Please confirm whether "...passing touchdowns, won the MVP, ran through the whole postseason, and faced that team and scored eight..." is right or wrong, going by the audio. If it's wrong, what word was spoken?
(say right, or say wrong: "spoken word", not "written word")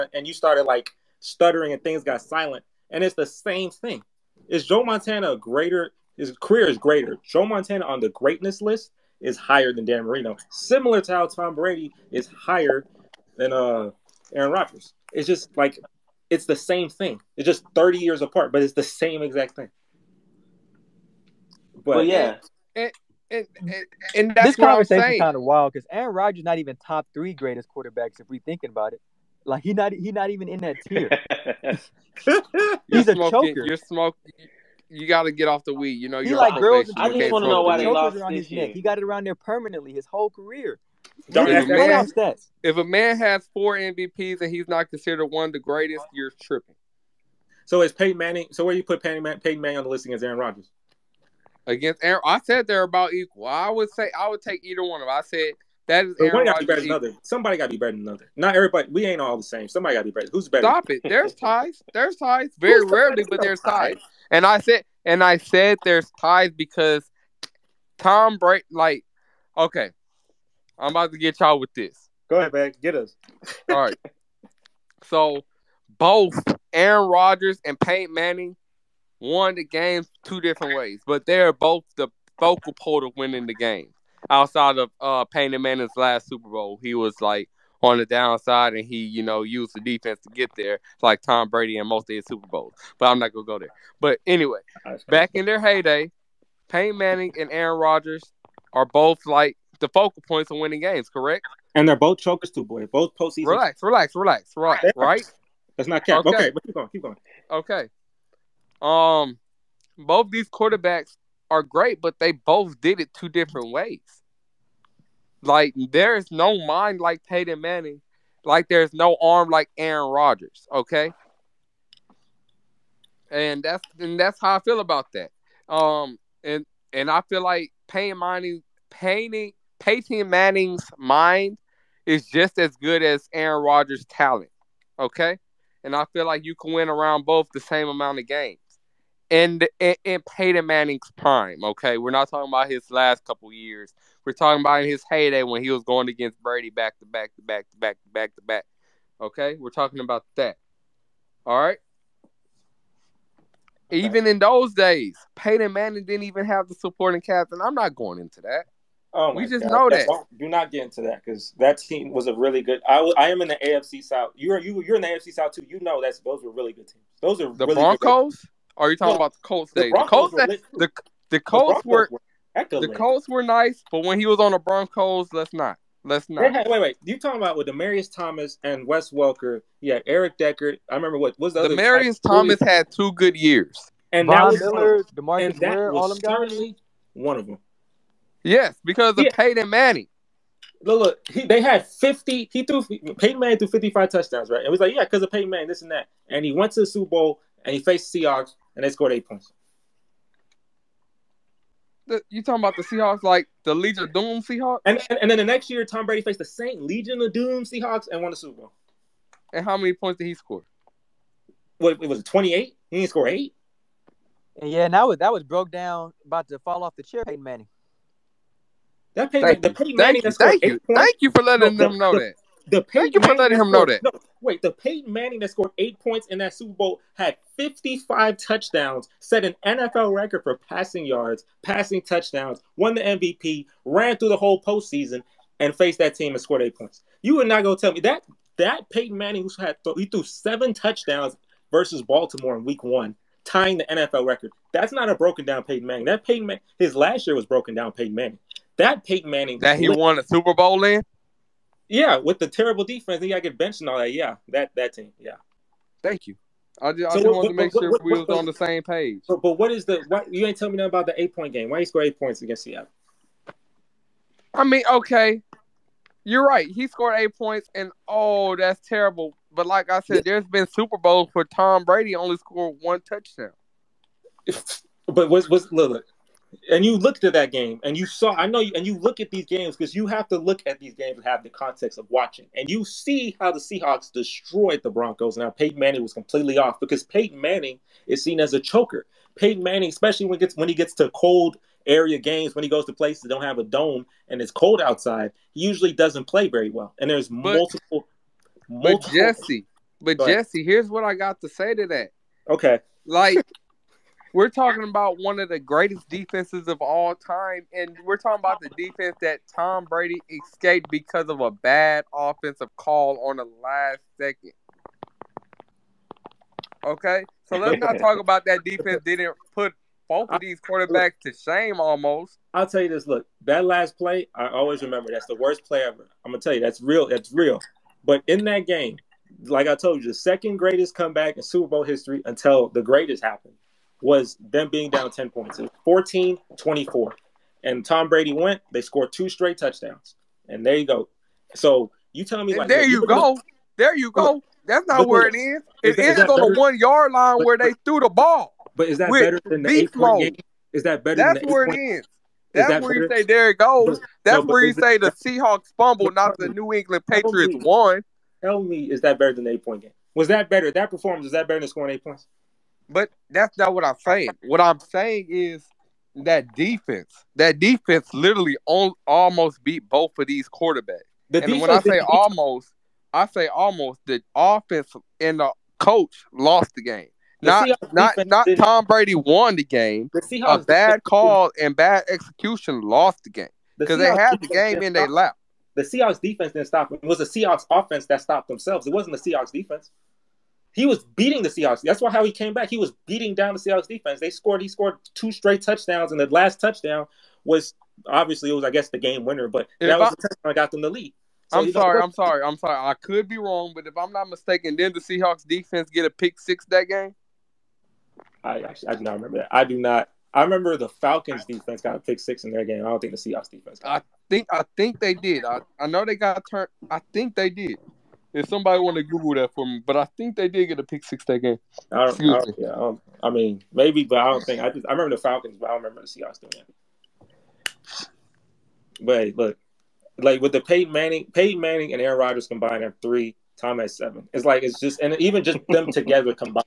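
right.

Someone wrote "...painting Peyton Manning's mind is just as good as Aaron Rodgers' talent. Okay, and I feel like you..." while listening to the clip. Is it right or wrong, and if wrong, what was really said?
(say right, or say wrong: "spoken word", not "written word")
right.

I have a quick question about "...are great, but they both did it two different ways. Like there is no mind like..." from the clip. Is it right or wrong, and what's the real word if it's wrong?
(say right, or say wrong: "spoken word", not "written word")
right.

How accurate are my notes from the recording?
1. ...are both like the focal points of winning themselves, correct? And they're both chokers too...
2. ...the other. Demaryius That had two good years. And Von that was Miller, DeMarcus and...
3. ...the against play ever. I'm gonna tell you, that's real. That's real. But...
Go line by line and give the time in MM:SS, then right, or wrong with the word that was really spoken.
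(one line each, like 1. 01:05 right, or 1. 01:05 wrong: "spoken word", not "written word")
1. 01:38 wrong: "games", not "themselves"
2. 03:01 wrong: "Thomas", not "That"
3. 05:25 wrong: "worst", not "against".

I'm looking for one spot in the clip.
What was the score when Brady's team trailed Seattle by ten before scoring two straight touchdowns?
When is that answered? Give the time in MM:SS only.
05:35.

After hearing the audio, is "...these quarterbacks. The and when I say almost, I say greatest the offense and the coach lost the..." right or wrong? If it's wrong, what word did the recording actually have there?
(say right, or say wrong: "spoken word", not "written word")
wrong: "almost", not "greatest".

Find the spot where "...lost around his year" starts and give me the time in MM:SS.
00:37.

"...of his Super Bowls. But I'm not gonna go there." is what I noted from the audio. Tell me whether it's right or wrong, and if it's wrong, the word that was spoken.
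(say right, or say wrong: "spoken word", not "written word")
right.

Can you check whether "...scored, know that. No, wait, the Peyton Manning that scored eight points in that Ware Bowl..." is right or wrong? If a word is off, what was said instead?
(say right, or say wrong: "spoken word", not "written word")
wrong: "Super", not "Ware".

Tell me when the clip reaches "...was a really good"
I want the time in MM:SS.
02:42.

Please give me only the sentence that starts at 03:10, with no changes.
Look, look he, they had fifty.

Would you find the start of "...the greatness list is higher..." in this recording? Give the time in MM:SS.
00:07.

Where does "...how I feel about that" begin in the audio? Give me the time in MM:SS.
02:04.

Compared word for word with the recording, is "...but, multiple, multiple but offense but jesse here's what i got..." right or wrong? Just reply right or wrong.
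wrong.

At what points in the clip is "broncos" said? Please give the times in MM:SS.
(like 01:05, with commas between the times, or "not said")
02:47, 02:54, 04:44.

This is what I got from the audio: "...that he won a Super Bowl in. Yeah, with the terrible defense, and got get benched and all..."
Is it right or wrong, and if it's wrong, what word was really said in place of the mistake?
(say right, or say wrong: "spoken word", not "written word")
right.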